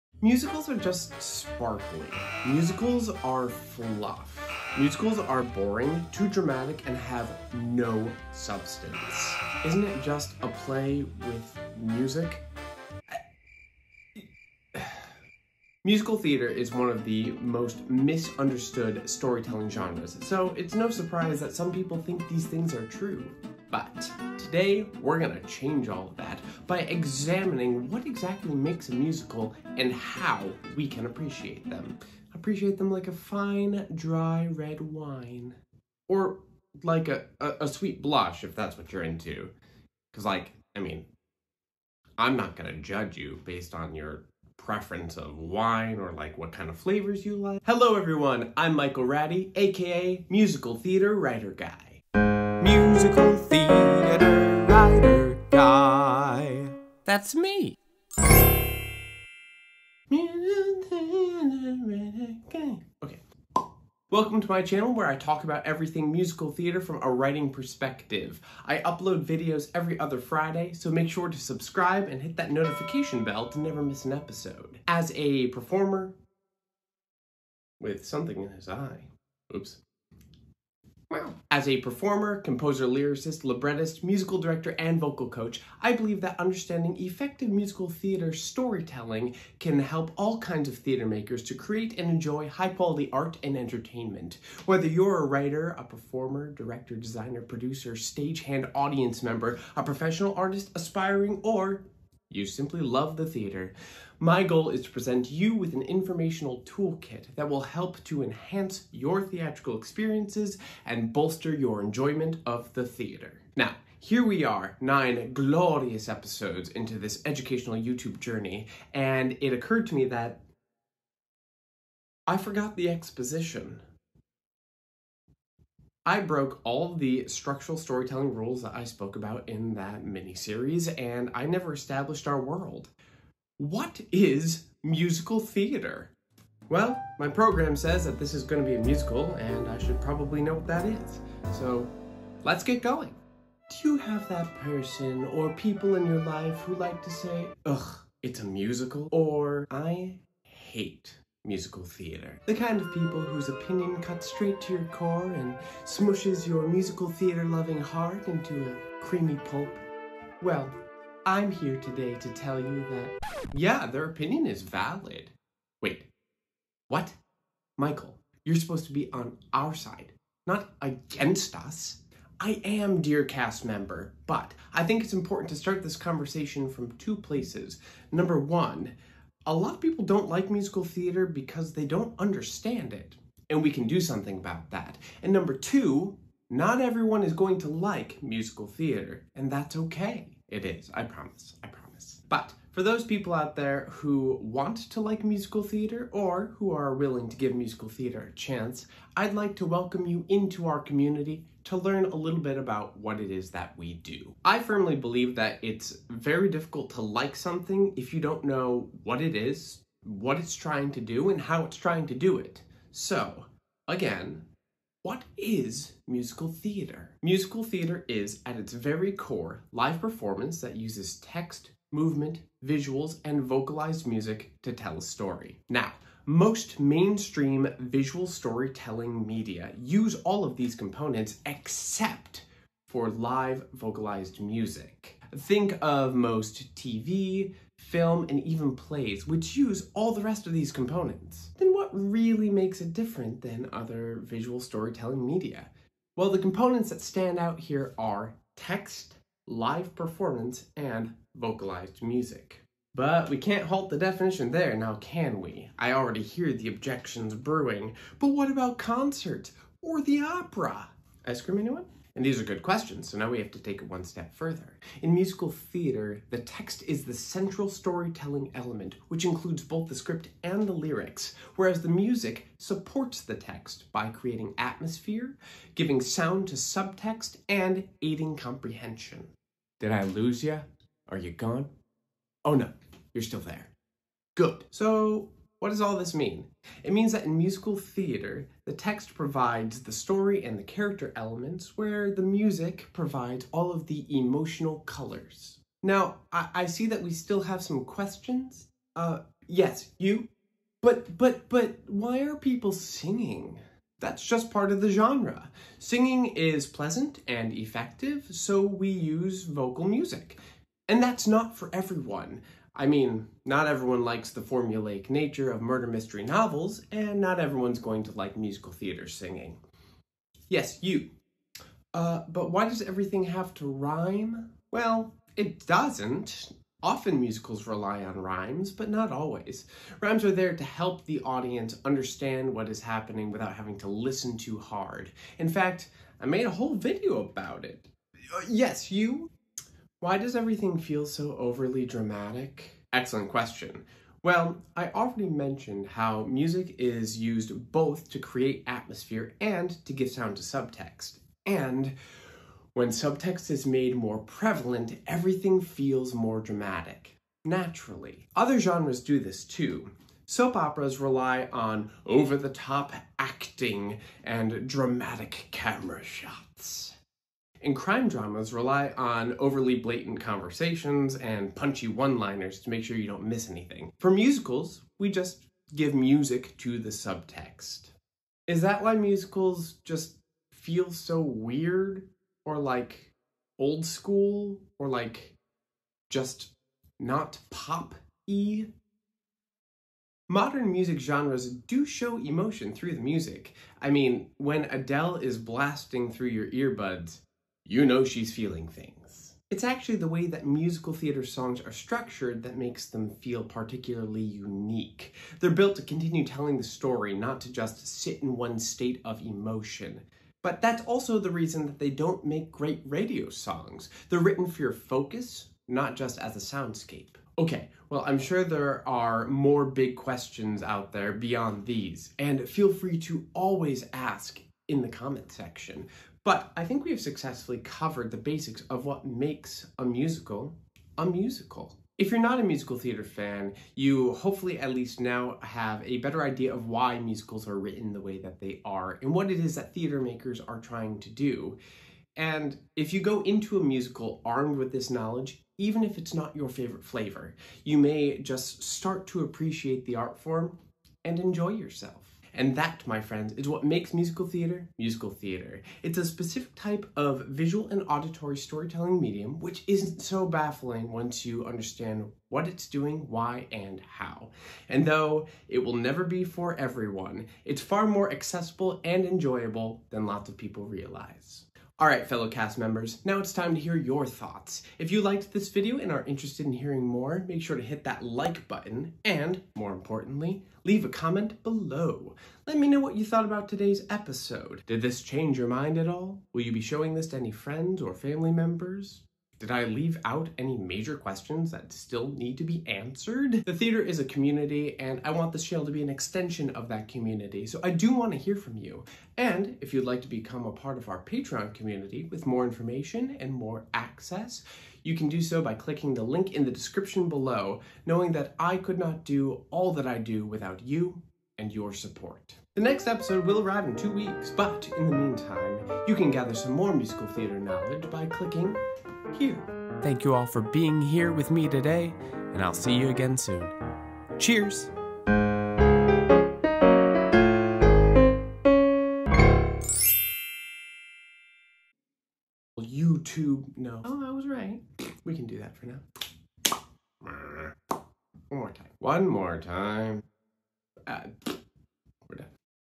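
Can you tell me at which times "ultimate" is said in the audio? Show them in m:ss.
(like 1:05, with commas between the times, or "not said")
not said.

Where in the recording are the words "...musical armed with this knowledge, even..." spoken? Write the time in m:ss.
7:23.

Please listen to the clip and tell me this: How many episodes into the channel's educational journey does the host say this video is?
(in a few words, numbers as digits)
9.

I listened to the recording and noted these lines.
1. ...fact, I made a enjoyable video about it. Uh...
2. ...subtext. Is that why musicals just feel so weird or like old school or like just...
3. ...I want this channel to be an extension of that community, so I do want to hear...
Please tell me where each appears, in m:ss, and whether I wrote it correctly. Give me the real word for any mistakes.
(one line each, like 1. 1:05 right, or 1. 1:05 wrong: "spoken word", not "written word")
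1. 5:35 wrong: "whole", not "enjoyable"
2. 6:16 right
3. 8:15 right.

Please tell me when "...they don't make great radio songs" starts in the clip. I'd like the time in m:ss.
6:51.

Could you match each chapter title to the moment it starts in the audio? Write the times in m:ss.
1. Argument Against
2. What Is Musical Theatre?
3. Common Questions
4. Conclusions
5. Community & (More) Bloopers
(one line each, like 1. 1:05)
1. 2:23
2. 3:24
3. 4:55
4. 6:57
5. 7:51.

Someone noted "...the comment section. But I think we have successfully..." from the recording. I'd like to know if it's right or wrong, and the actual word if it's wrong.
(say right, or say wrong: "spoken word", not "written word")
right.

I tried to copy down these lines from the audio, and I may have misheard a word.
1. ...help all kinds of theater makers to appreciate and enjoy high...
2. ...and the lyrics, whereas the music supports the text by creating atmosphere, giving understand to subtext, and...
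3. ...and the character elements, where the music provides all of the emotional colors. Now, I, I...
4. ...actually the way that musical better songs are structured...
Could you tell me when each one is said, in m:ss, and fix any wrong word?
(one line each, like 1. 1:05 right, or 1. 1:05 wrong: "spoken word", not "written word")
1. 1:29 wrong: "create", not "appreciate"
2. 4:30 wrong: "sound", not "understand"
3. 4:50 right
4. 6:39 wrong: "theater", not "better".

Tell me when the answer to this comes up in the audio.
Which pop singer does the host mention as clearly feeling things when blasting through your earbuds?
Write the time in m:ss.
6:34.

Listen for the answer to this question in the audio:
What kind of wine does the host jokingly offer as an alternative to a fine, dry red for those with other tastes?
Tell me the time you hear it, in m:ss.
0:37.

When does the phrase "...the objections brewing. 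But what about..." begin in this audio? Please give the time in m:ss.
4:16.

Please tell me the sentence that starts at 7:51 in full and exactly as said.
Alright fellow cast members, now it's time to hear your thoughts.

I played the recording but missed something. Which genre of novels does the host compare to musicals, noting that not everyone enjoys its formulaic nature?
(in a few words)
Murder mystery.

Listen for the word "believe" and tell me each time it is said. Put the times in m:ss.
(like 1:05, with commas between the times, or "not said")
1:25, 3:24.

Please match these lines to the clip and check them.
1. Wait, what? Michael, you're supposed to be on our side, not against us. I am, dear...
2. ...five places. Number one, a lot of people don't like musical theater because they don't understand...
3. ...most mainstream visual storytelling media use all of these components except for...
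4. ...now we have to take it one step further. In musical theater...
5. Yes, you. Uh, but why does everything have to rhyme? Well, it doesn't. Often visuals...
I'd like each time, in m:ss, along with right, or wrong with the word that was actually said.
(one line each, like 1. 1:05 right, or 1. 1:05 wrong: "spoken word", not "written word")
1. 2:45 right
2. 2:56 wrong: "two", not "five"
3. 3:46 right
4. 4:23 right
5. 5:20 wrong: "musicals", not "visuals".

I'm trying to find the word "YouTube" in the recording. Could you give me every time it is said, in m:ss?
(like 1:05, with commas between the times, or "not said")
1:57, 8:52.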